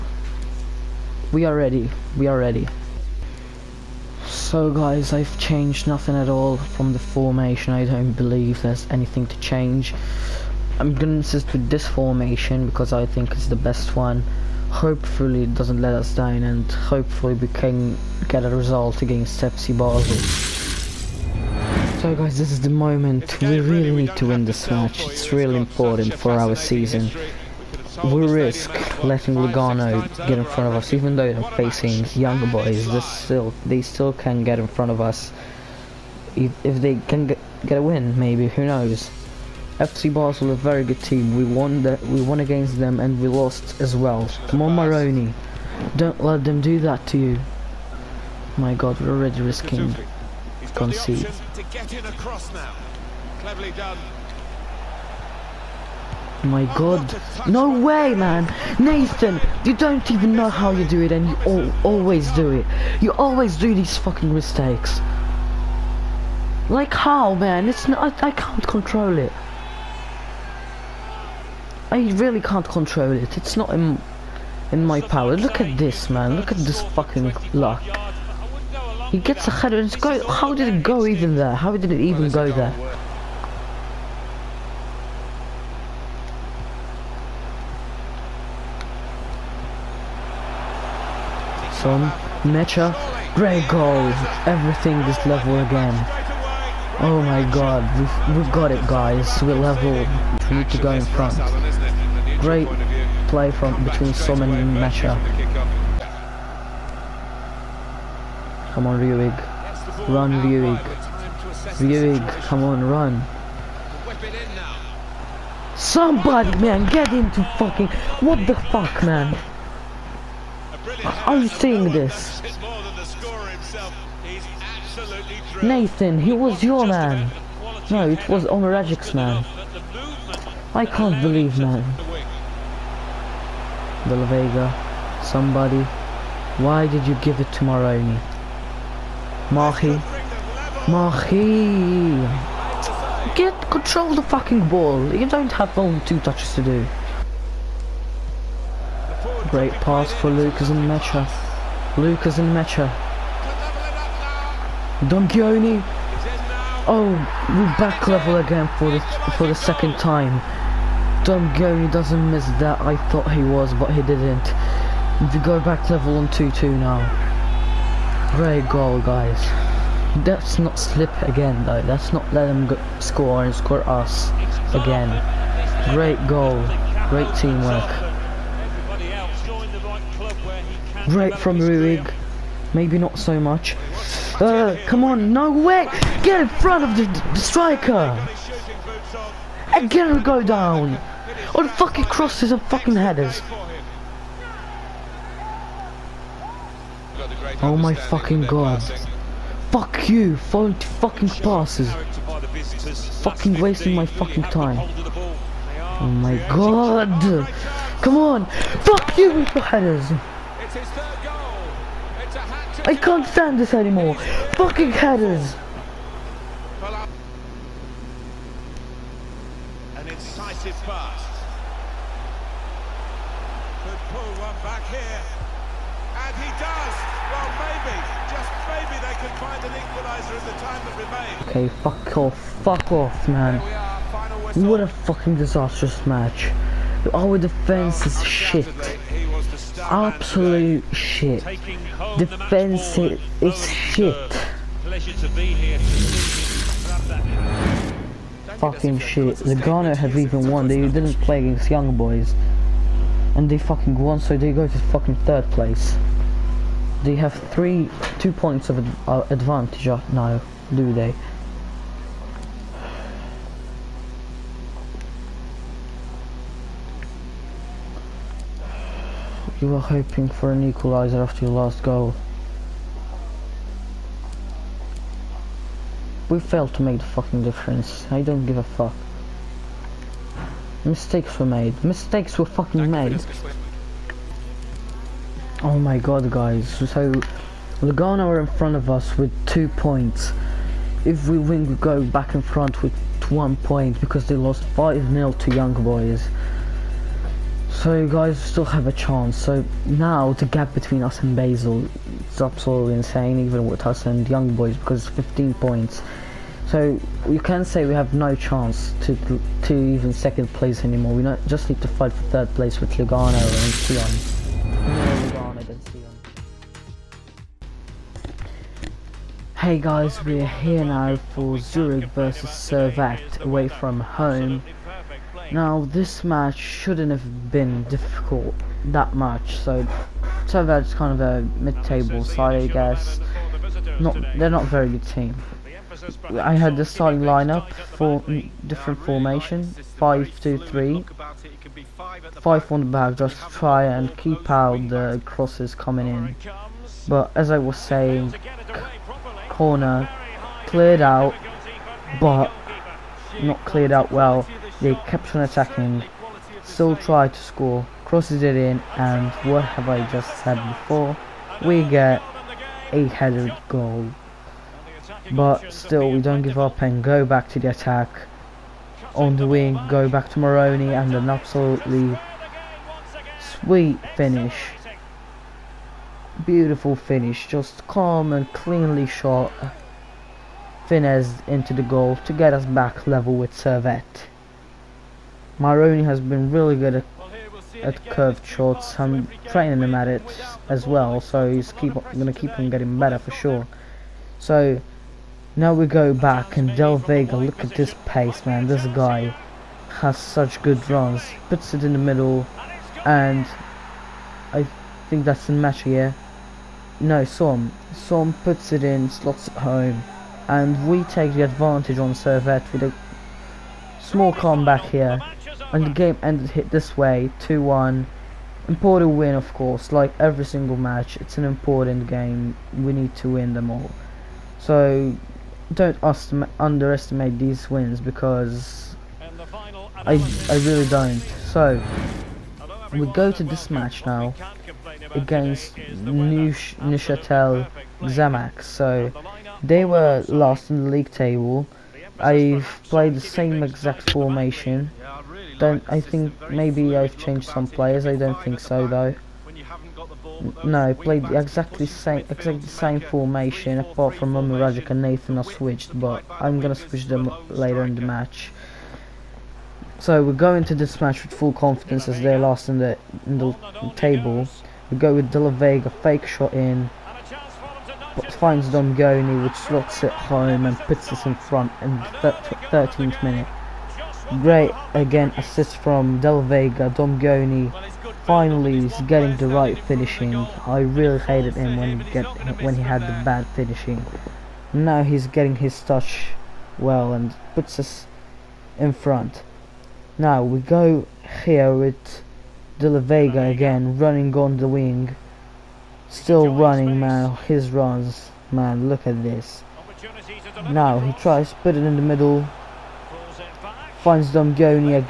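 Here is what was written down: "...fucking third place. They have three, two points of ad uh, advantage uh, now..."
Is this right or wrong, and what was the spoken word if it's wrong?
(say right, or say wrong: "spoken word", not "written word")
right.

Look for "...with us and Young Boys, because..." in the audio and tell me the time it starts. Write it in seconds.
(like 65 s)
303 s.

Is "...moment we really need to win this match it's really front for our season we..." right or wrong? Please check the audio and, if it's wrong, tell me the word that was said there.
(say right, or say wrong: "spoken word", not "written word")
wrong: "important", not "front".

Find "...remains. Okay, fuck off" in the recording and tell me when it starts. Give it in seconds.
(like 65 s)
230 s.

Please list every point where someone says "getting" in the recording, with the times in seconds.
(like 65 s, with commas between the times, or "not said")
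392 s, 479 s, 485 s.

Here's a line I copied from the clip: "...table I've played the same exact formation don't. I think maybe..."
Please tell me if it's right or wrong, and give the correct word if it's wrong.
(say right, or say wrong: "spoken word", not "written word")
right.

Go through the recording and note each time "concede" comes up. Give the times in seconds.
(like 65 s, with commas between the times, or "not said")
50 s.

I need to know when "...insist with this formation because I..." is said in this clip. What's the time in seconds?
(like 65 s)
11 s.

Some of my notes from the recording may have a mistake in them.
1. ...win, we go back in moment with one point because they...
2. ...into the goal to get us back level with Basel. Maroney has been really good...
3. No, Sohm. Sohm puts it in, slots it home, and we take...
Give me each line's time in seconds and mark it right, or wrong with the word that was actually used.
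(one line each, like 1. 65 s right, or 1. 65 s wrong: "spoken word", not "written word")
1. 291 s wrong: "front", not "moment"
2. 381 s wrong: "Servette", not "Basel"
3. 407 s right.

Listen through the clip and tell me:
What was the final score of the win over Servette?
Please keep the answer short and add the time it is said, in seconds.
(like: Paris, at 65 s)
2-1, at 417 s.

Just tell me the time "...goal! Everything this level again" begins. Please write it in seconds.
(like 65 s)
93 s.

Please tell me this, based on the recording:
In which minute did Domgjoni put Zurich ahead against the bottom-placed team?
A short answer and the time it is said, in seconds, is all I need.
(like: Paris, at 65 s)
13th, at 472 s.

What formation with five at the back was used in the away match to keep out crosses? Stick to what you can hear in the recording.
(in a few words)
5-2-3.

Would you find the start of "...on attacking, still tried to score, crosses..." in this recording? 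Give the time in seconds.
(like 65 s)
355 s.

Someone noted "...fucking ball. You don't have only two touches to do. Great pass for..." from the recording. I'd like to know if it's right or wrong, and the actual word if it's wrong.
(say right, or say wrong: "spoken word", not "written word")
right.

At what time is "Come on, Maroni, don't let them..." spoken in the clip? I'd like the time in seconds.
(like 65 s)
44 s.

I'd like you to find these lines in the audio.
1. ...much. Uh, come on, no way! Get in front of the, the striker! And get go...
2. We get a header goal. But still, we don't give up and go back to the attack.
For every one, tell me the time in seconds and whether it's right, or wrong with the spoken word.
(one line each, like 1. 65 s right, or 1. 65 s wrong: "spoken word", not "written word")
1. 183 s right
2. 361 s right.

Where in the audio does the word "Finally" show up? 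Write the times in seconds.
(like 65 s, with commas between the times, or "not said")
478 s.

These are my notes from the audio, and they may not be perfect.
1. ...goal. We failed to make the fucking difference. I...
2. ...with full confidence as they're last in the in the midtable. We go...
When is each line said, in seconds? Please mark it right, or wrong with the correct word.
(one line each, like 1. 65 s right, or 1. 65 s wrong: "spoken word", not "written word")
1. 271 s right
2. 461 s wrong: "table", not "midtable".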